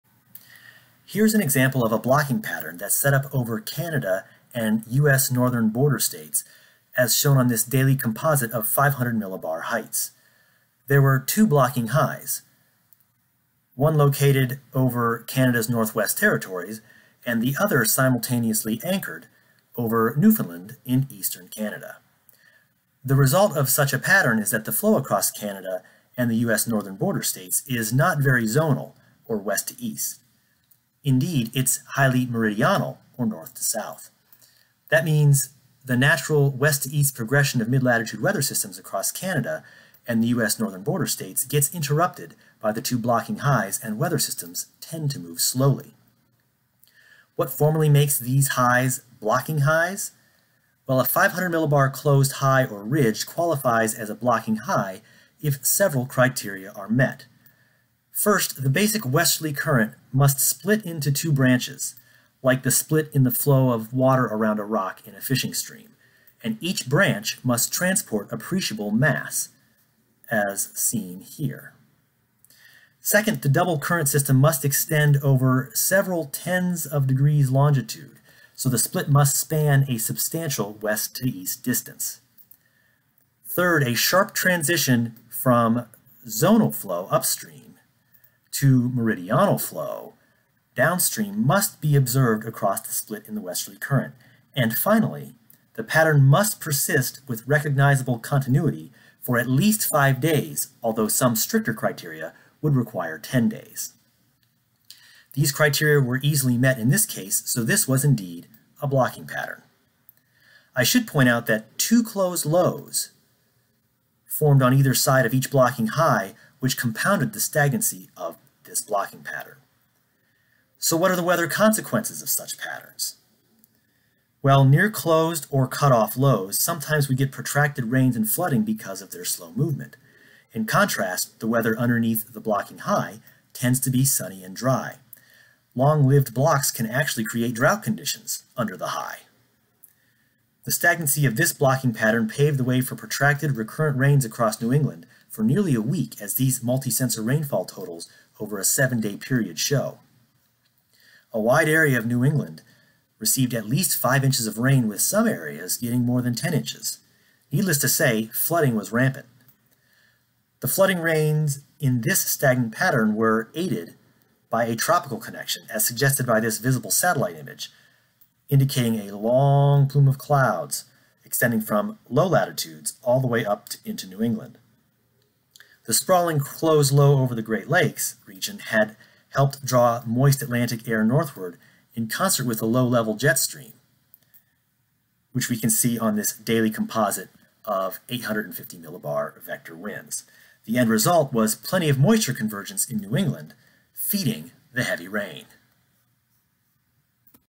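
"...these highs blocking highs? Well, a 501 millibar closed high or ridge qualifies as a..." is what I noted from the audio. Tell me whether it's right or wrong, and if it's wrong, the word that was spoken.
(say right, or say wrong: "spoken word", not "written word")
wrong: "500", not "501".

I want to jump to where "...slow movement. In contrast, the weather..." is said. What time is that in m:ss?
2:09.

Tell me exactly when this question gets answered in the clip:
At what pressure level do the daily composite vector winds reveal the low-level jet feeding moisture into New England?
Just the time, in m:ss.
3:08.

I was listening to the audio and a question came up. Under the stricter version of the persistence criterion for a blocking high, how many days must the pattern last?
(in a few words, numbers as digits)
10 days.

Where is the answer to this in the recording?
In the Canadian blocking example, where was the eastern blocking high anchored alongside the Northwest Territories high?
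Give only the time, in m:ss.
0:20.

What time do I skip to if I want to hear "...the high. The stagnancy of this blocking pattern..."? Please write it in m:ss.
2:18.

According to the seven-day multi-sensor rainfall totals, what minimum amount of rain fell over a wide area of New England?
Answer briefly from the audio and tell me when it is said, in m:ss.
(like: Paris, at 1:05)
5 inches, at 2:33.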